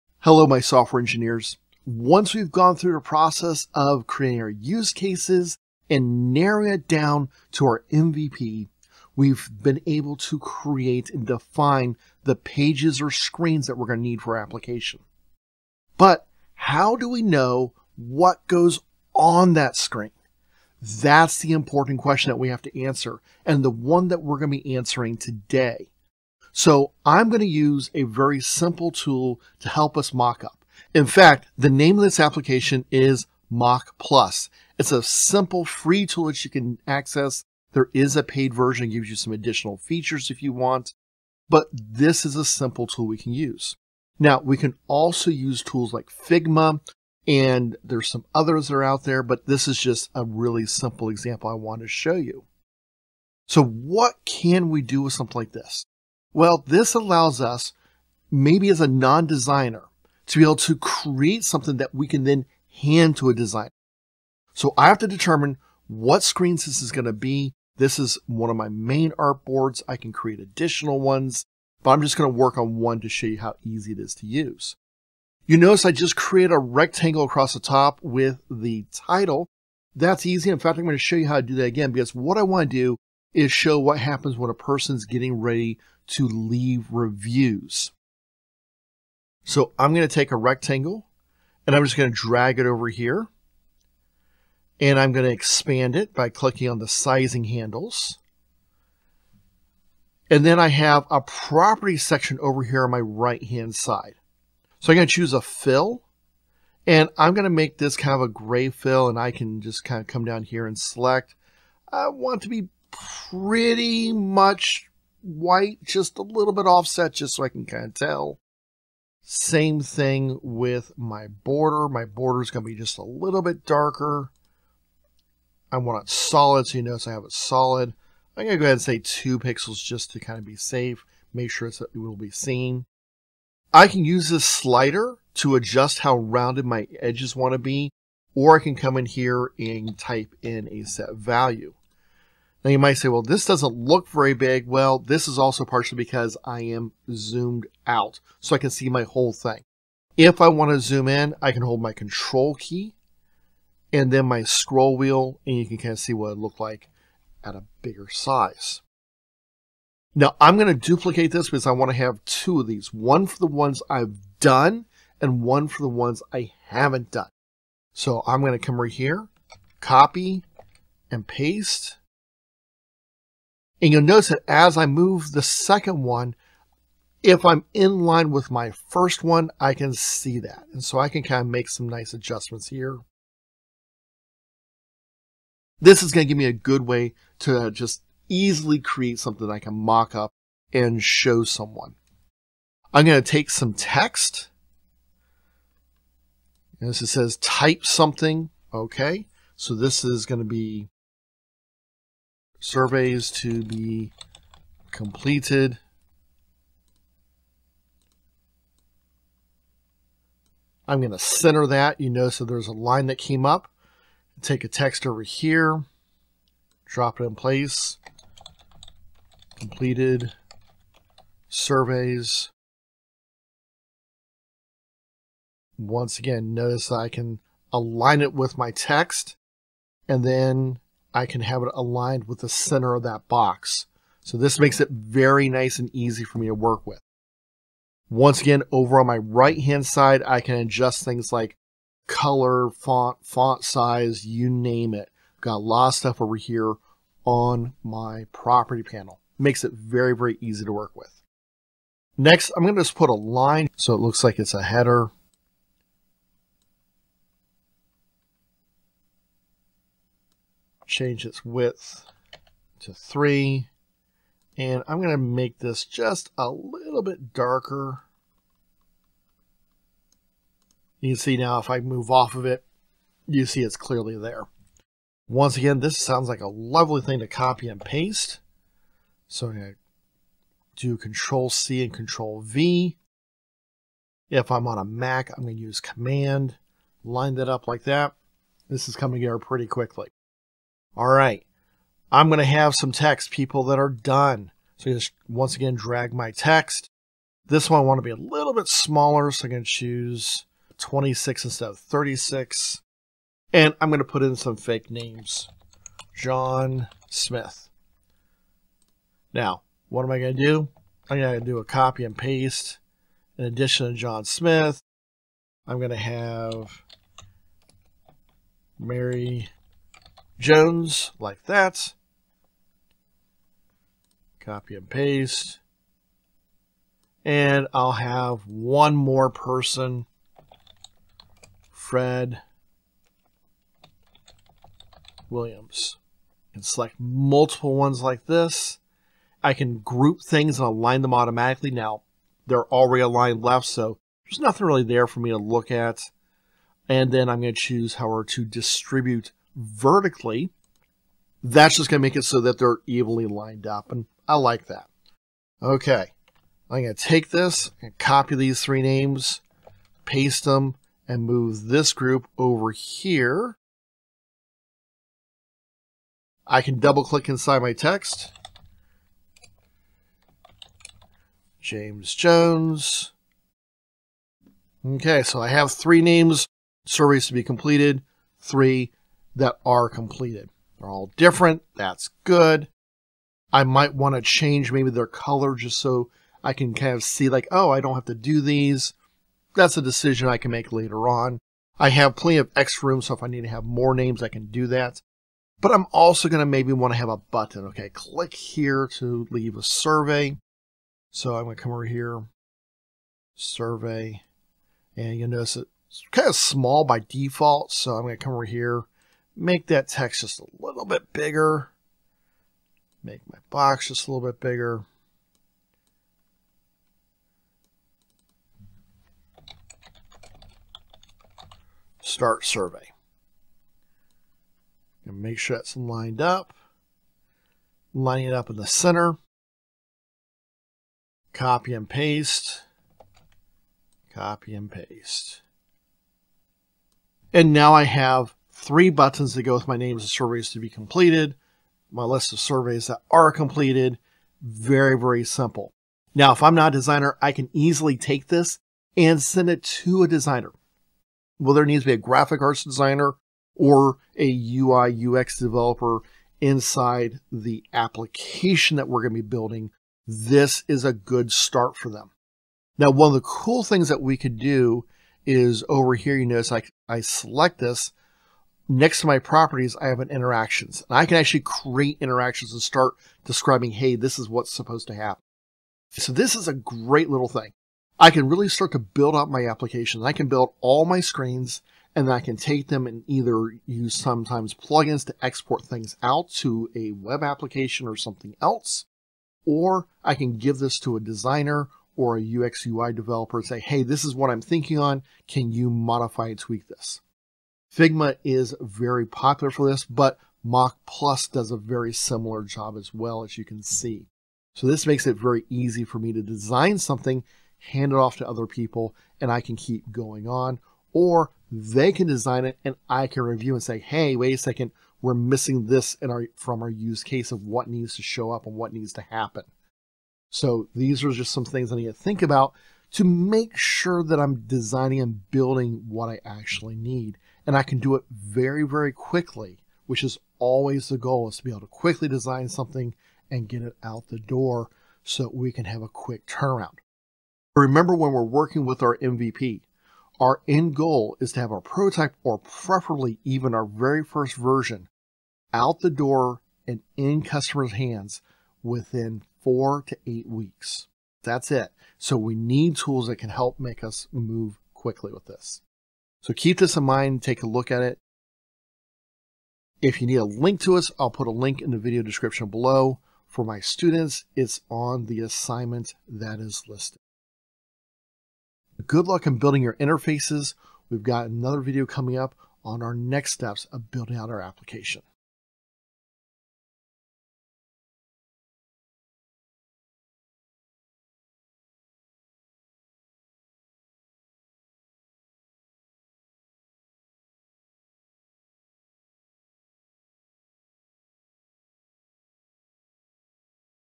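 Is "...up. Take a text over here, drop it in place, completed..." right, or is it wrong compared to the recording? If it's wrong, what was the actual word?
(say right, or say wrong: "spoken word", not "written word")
right.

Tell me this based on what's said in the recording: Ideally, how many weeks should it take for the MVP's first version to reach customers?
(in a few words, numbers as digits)
4 to 8 weeks.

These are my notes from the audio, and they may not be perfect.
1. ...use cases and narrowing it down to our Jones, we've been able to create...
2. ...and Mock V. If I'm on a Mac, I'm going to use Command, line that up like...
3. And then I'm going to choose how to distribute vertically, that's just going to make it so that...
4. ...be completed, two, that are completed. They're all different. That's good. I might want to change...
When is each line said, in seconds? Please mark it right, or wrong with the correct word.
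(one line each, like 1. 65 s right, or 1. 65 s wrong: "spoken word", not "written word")
1. 4 s wrong: "MVP", not "Jones"
2. 281 s wrong: "Control", not "Mock"
3. 346 s right
4. 377 s wrong: "three", not "two".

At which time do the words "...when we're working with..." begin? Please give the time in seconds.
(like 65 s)
537 s.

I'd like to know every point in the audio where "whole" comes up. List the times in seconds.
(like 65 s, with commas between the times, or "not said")
149 s.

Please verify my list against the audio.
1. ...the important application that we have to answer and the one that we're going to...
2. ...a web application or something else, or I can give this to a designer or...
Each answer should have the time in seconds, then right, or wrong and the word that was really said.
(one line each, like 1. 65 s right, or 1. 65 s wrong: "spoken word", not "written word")
1. 21 s wrong: "question", not "application"
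2. 486 s right.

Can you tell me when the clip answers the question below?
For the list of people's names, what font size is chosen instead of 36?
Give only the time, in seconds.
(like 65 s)
300 s.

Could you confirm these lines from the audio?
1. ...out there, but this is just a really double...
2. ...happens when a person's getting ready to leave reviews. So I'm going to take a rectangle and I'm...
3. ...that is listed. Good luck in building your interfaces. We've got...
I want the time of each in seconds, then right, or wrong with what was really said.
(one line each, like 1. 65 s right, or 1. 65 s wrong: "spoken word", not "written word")
1. 48 s wrong: "simple", not "double"
2. 83 s right
3. 566 s right.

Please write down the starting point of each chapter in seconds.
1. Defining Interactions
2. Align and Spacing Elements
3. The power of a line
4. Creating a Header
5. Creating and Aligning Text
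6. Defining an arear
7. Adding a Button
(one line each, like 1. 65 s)
1. 462 s
2. 339 s
3. 251 s
4. 75 s
5. 229 s
6. 89 s
7. 395 s.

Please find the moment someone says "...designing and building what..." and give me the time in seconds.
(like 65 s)
524 s.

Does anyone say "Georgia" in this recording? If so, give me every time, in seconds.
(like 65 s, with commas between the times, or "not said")
not said.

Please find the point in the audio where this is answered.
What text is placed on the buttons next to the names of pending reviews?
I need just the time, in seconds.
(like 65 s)
422 s.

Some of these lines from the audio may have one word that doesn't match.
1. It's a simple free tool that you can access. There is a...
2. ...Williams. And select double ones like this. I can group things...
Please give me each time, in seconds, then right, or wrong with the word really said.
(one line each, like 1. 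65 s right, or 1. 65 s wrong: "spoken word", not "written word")
1. 34 s right
2. 335 s wrong: "multiple", not "double".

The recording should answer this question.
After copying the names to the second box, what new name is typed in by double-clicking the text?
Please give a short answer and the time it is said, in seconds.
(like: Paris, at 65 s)
James Jones, at 371 s.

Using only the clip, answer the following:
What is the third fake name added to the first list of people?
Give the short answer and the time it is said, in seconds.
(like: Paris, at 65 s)
Fred Williams, at 331 s.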